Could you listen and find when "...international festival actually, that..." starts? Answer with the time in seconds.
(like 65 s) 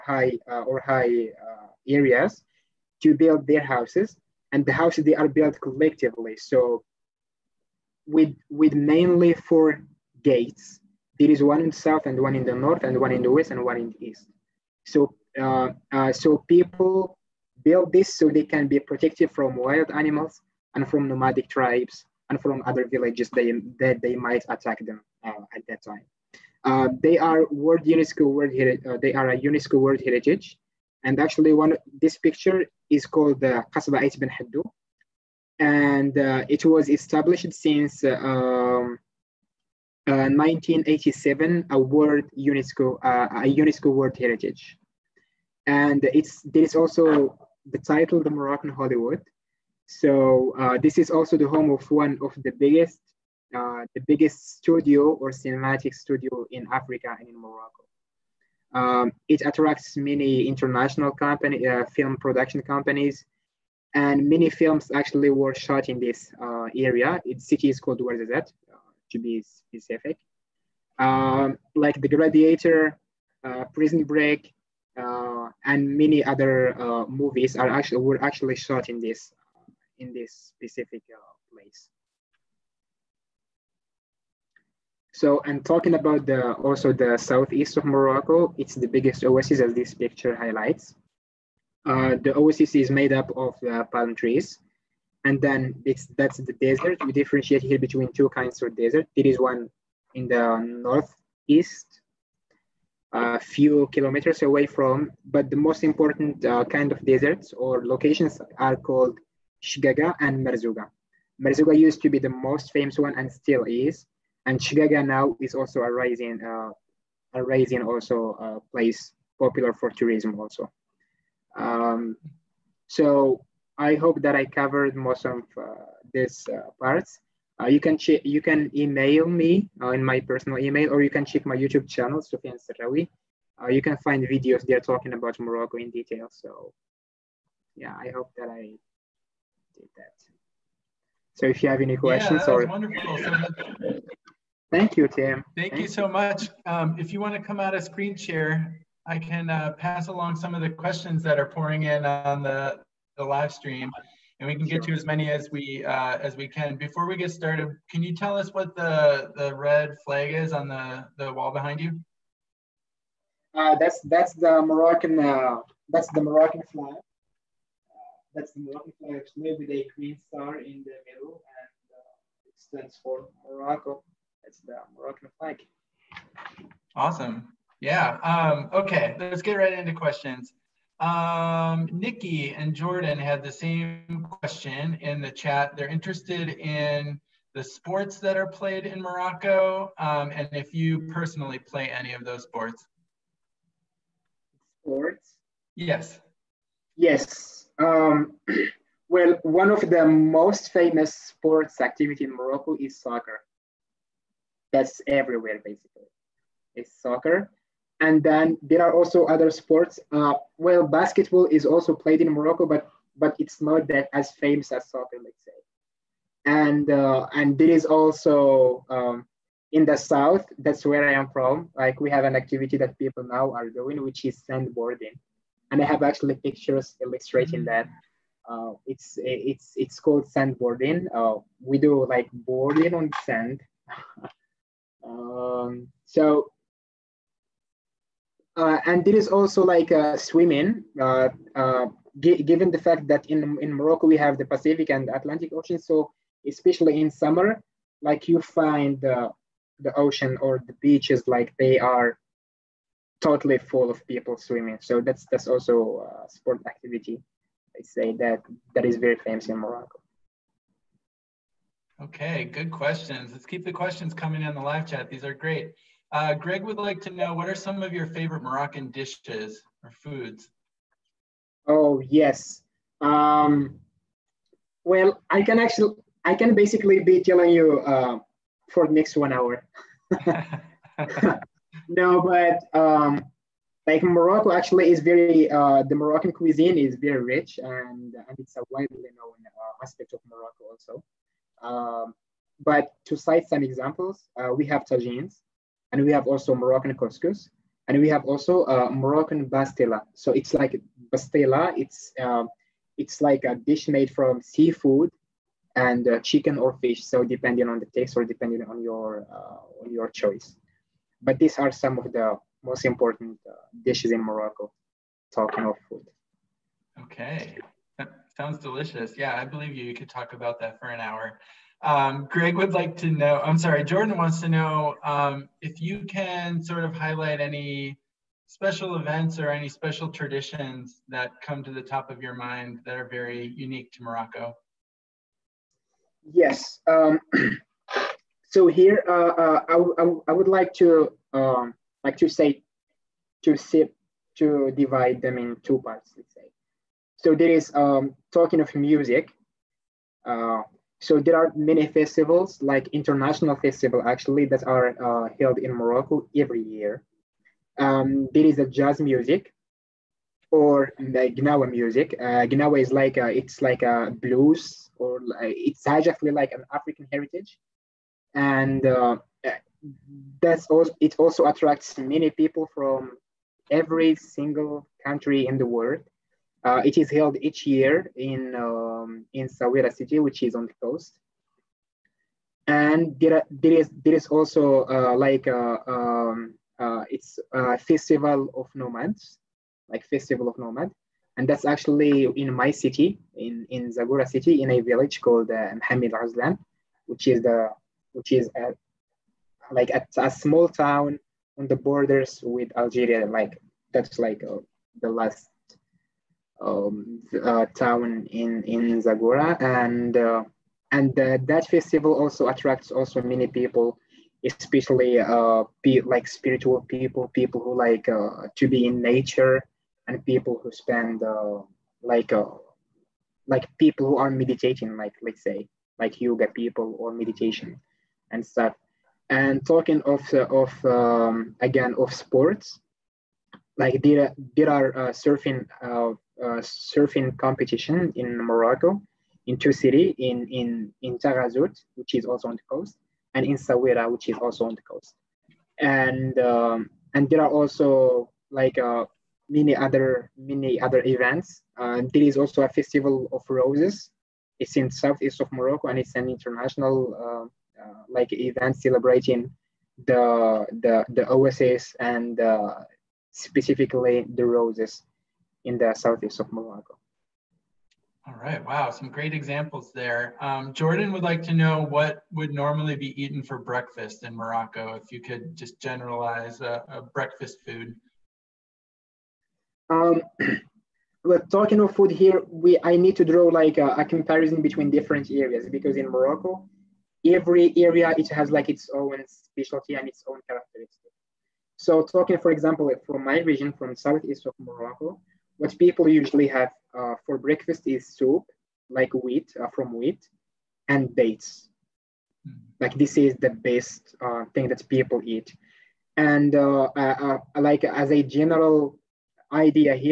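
352 s.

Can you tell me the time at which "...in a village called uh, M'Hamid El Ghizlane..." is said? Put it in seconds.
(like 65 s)
394 s.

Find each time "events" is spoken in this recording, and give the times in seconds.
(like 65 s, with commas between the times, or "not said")
328 s, 451 s, 458 s.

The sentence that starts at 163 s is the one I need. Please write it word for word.
Uh, that's that's the Moroccan uh, that's the Moroccan flag.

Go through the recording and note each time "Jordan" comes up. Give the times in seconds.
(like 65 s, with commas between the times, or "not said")
182 s, 323 s, 470 s.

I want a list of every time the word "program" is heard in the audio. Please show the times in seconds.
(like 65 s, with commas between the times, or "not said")
not said.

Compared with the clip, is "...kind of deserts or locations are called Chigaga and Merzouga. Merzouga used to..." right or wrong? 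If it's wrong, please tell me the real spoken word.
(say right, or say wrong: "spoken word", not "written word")
right.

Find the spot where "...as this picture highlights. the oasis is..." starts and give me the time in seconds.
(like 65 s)
89 s.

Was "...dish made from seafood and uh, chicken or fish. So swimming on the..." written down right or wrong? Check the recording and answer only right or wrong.
wrong.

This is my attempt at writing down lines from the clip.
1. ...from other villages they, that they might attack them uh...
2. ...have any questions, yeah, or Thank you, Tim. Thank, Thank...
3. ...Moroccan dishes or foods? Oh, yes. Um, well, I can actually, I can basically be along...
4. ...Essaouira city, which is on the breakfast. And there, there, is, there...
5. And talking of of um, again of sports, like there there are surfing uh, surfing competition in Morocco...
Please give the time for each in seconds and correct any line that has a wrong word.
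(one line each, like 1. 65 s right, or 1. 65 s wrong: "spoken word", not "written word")
1. 22 s right
2. 141 s right
3. 268 s wrong: "telling", not "along"
4. 379 s wrong: "coast", not "breakfast"
5. 429 s right.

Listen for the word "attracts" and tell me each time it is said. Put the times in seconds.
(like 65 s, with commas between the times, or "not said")
59 s, 371 s, 412 s.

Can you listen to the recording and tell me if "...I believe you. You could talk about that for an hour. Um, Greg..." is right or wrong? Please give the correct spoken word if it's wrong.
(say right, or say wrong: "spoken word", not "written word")
right.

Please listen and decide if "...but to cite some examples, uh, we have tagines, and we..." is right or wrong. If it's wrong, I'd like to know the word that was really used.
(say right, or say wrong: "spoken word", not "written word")
right.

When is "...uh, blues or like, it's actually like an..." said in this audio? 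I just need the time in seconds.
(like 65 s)
364 s.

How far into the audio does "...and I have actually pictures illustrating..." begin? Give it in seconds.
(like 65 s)
225 s.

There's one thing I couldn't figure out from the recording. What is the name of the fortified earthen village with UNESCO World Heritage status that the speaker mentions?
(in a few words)
Qasba Ait Benhaddou.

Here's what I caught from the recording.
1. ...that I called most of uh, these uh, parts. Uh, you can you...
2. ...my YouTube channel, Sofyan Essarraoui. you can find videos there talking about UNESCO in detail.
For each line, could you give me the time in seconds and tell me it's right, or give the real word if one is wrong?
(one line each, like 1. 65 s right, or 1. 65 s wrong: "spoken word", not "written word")
1. 124 s wrong: "covered", not "called"
2. 131 s wrong: "Morocco", not "UNESCO".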